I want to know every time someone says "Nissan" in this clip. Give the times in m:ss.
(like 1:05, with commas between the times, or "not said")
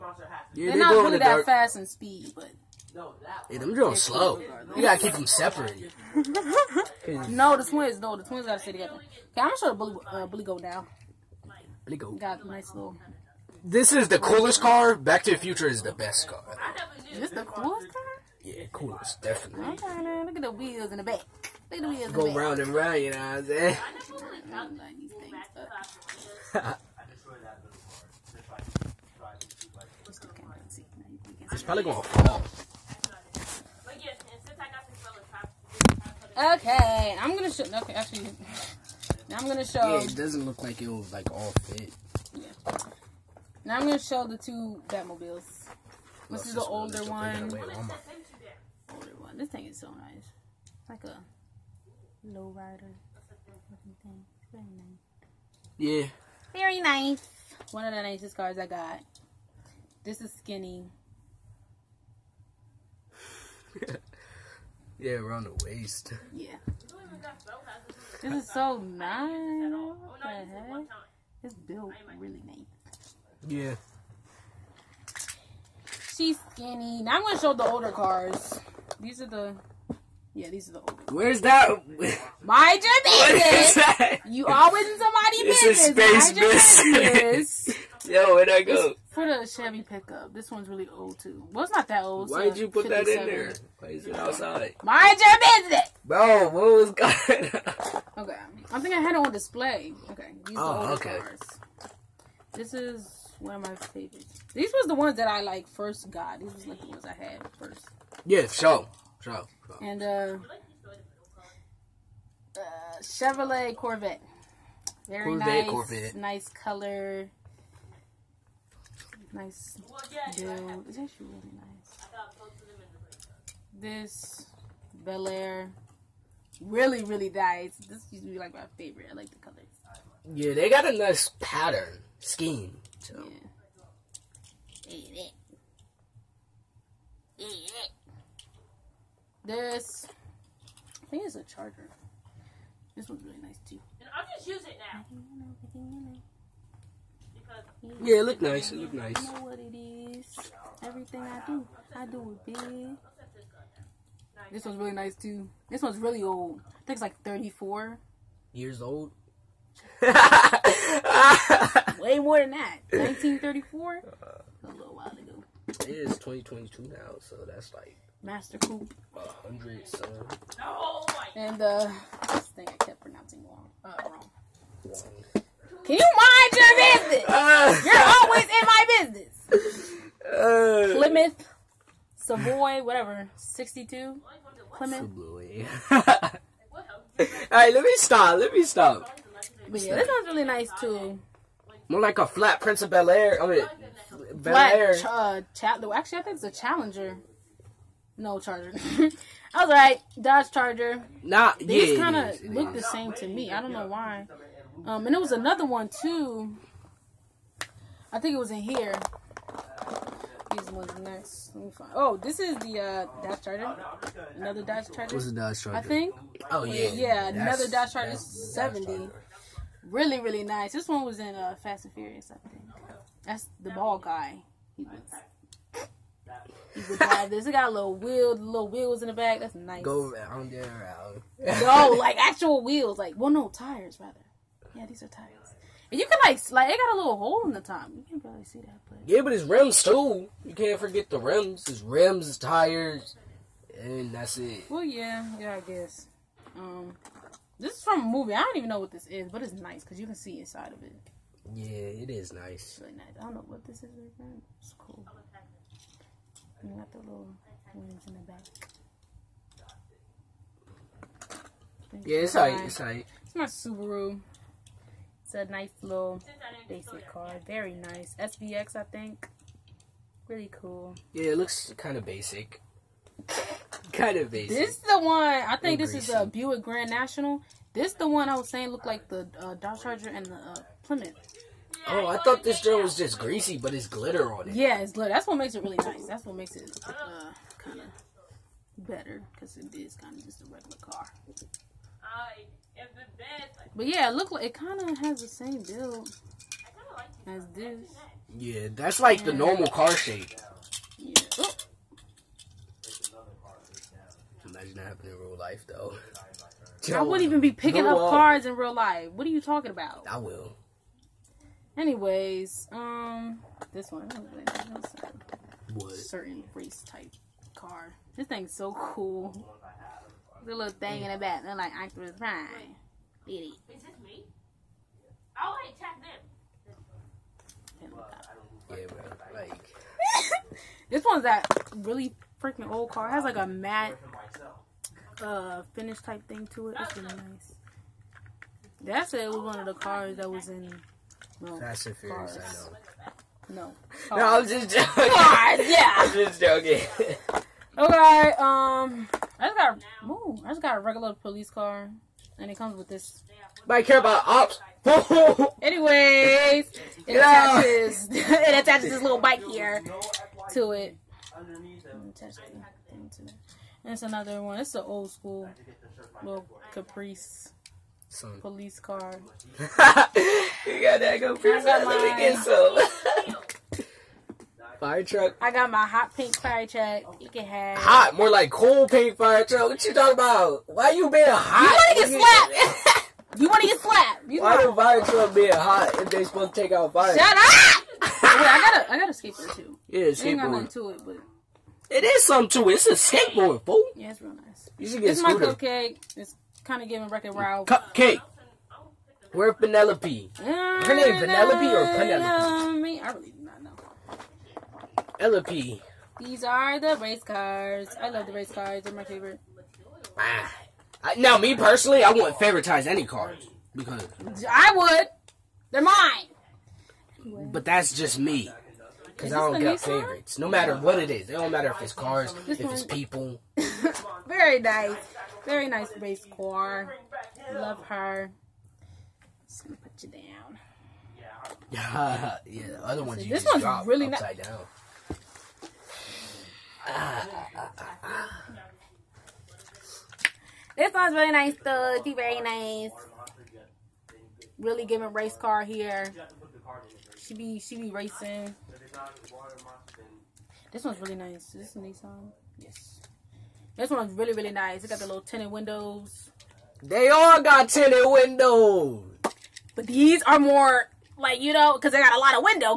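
7:31.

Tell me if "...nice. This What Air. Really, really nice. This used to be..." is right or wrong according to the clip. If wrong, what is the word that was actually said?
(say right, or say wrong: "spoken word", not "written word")
wrong: "Bel", not "What".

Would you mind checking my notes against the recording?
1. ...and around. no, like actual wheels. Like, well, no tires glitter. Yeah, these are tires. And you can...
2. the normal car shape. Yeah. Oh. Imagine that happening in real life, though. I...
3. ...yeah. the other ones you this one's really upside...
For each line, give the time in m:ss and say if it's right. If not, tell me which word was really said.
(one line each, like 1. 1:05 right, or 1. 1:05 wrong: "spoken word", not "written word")
1. 3:50 wrong: "rather", not "glitter"
2. 4:59 right
3. 7:12 right.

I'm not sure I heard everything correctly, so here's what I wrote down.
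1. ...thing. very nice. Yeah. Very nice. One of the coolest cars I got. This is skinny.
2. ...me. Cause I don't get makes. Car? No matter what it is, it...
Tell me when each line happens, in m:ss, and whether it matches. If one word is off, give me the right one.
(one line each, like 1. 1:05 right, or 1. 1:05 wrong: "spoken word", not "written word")
1. 0:54 wrong: "nicest", not "coolest"
2. 6:58 wrong: "favorites", not "makes".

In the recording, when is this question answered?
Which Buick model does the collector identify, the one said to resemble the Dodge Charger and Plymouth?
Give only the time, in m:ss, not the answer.
4:36.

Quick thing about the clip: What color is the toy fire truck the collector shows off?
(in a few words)
Hot pink.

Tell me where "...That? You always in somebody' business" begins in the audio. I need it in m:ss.
1:23.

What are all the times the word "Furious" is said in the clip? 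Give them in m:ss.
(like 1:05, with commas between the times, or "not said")
3:41, 5:41.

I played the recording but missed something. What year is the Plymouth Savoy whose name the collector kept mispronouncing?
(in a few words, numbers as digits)
62.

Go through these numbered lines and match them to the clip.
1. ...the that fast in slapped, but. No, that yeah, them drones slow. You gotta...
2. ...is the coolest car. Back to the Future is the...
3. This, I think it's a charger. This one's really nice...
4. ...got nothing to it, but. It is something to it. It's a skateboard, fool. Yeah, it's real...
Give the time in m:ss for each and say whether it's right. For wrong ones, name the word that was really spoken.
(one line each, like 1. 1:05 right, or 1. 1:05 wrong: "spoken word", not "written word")
1. 0:01 wrong: "speed", not "slapped"
2. 0:13 right
3. 2:19 right
4. 6:30 right.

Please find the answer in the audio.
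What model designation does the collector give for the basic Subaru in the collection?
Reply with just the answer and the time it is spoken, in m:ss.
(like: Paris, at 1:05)
SVX, at 4:28.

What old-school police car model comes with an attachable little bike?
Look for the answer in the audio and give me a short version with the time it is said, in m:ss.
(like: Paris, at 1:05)
Caprice, at 6:06.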